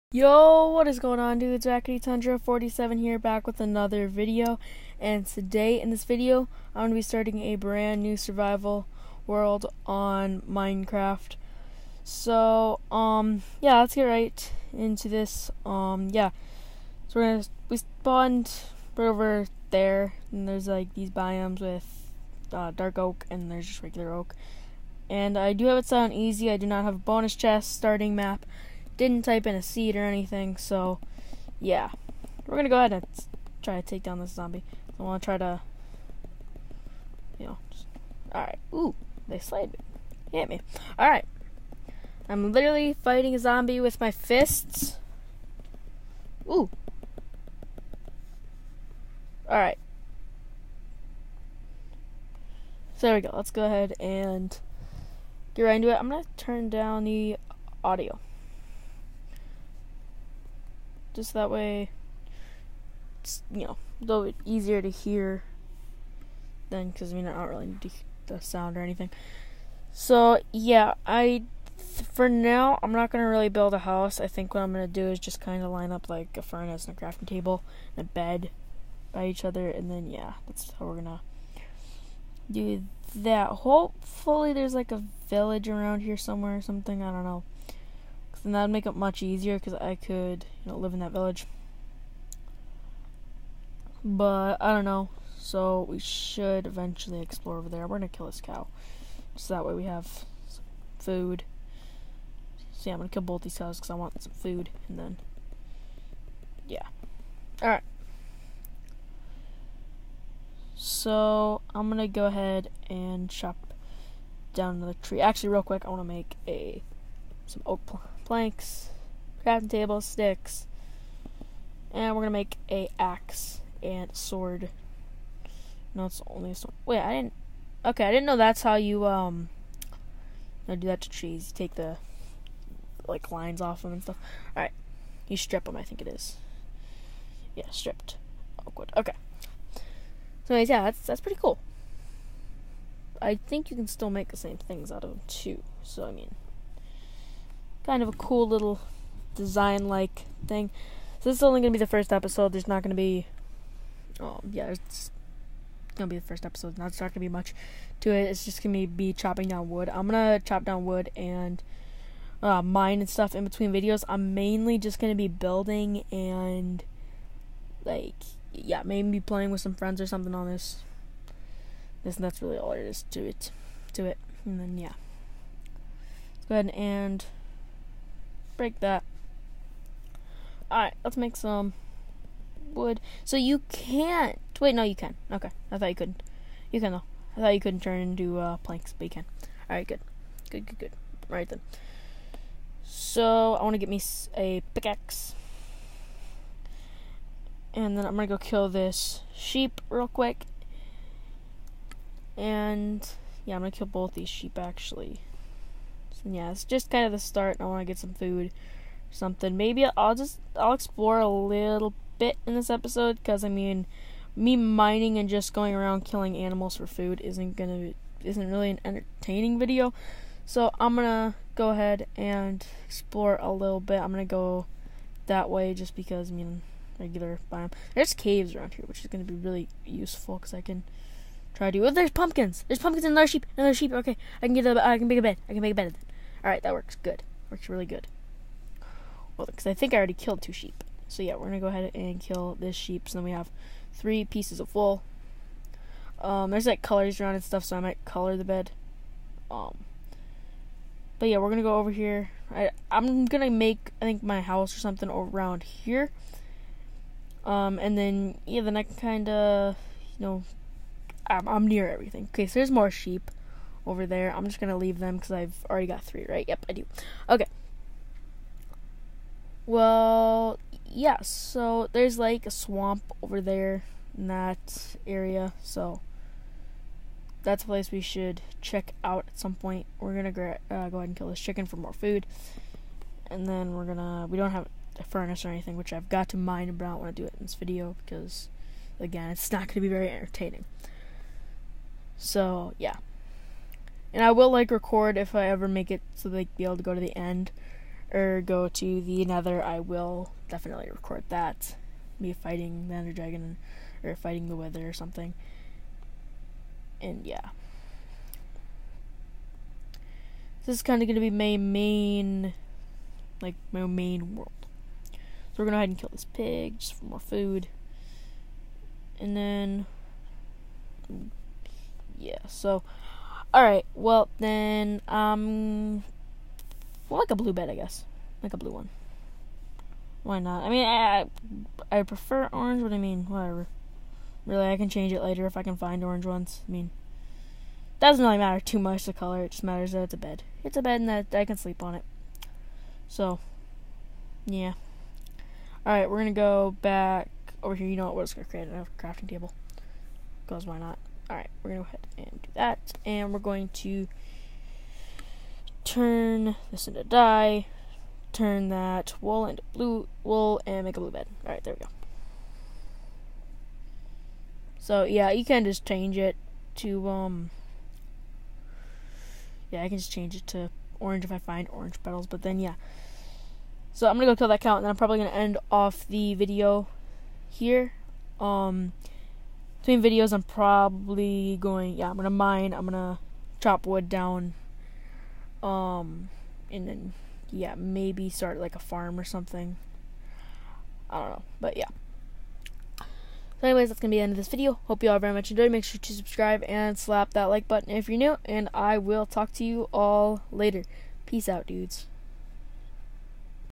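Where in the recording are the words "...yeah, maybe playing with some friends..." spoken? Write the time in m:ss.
2:48.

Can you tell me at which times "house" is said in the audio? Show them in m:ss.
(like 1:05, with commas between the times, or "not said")
1:13, 4:14.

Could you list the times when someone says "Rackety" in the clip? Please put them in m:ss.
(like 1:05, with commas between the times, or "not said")
0:01.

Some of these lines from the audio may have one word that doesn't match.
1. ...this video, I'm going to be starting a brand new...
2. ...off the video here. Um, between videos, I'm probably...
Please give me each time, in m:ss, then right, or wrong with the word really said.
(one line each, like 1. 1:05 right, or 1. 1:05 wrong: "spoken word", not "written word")
1. 0:05 right
2. 6:15 right.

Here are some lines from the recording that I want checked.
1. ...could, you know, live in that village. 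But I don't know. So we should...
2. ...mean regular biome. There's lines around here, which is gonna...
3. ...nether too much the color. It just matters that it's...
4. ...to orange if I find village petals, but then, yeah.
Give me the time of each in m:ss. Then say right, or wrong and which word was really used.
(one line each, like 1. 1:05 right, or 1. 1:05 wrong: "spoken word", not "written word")
1. 1:29 right
2. 3:46 wrong: "caves", not "lines"
3. 5:38 wrong: "matter", not "nether"
4. 6:10 wrong: "orange", not "village".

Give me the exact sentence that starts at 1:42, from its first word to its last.
So yeah, I'm gonna kill both these cows because I want some food and then yeah.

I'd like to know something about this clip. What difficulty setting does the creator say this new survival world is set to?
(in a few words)
Easy.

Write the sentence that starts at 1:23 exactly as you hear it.
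Hopefully there's like a village around here somewhere or something.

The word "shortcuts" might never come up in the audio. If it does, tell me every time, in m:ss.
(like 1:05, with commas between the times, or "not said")
not said.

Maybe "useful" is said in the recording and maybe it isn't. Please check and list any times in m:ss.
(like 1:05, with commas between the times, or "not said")
3:49.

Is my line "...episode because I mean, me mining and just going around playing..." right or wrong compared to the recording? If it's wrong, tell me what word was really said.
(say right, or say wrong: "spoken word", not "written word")
wrong: "killing", not "playing".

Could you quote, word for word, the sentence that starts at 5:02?
Me fighting the Ender Dragon or fighting the Wither or something.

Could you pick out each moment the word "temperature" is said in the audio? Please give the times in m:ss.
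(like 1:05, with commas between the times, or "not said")
not said.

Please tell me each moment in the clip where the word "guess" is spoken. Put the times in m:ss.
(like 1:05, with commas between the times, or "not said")
5:27.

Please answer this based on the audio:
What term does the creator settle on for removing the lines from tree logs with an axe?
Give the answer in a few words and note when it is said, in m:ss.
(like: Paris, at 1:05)
Stripped, at 2:17.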